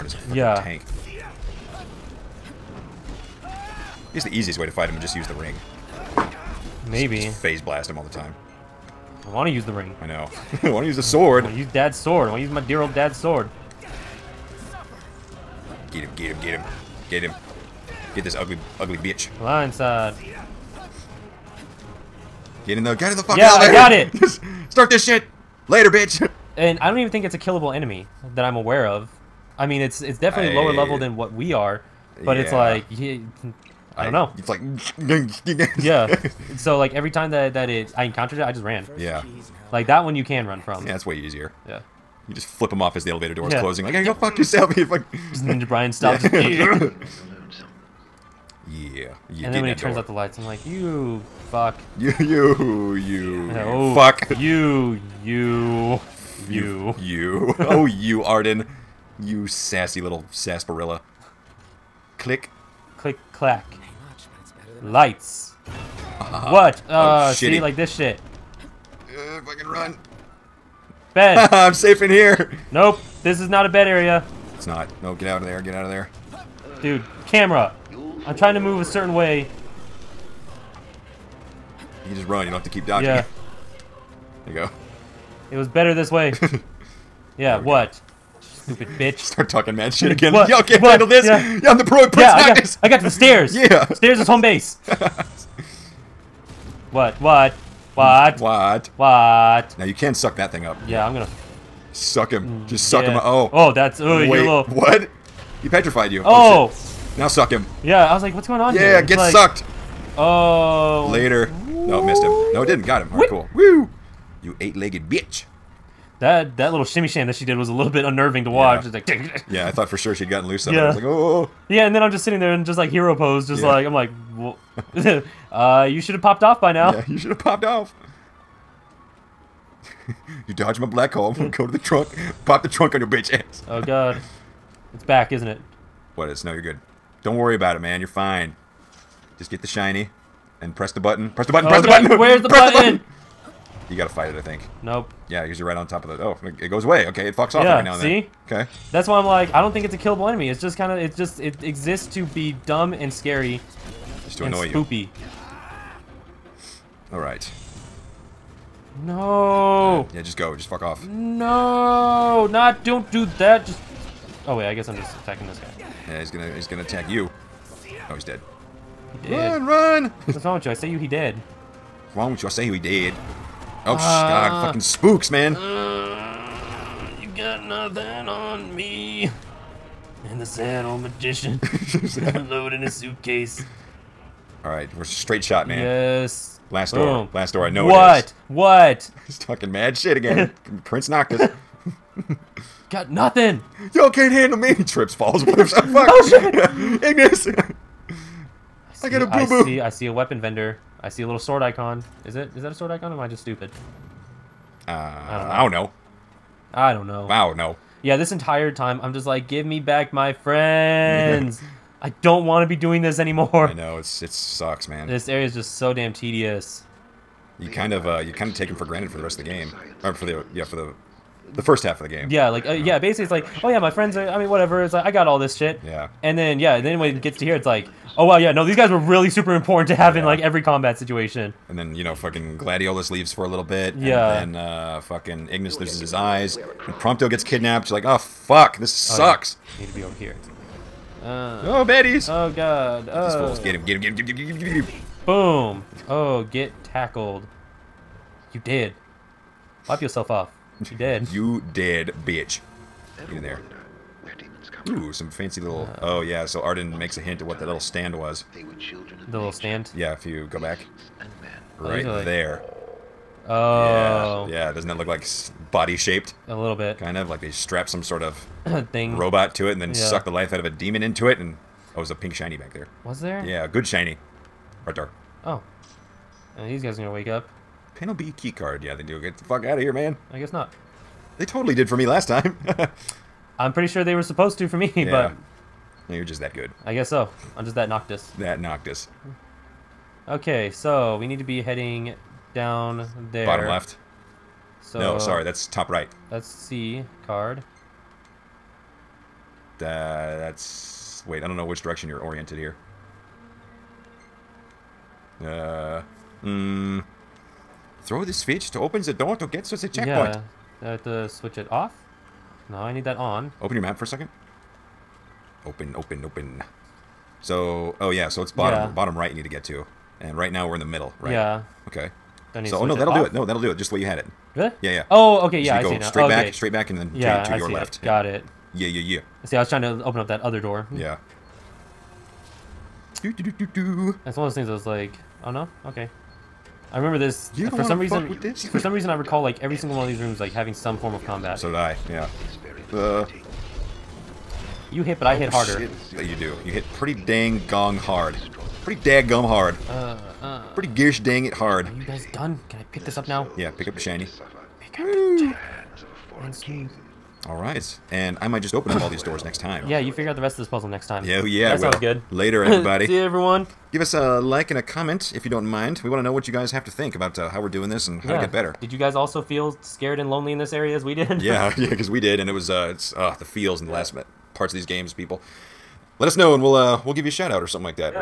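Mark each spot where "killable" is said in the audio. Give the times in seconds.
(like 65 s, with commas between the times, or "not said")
27 s, 149 s.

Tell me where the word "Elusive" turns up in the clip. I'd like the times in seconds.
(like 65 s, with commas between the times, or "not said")
not said.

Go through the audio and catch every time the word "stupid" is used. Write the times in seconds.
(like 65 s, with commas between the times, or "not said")
88 s, 203 s.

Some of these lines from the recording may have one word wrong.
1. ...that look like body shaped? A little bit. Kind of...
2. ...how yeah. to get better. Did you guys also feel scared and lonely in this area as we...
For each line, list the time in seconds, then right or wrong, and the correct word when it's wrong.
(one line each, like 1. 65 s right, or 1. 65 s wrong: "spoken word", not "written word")
1. 264 s right
2. 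368 s right.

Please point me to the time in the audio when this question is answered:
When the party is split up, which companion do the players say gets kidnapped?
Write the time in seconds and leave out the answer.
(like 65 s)
236 s.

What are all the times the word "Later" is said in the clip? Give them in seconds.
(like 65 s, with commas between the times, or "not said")
25 s, 111 s, 362 s.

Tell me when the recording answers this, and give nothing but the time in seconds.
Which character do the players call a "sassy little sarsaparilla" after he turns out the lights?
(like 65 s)
58 s.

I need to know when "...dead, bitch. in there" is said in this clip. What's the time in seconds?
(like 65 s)
251 s.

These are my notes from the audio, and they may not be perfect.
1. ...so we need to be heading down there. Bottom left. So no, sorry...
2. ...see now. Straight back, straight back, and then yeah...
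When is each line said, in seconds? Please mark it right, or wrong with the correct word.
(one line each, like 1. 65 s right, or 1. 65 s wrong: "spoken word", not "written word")
1. 290 s right
2. 325 s right.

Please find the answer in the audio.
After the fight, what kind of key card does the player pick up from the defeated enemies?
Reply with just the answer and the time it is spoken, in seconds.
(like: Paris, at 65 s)
Penalty key card, at 277 s.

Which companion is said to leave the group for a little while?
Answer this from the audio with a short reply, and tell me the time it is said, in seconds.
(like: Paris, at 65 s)
Gladiolus, at 232 s.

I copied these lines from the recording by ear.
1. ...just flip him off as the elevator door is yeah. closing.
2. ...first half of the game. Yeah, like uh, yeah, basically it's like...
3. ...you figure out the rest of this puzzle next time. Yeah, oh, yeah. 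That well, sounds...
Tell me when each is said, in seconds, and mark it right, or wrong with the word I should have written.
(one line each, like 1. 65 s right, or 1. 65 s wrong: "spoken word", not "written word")
1. 42 s right
2. 221 s right
3. 359 s right.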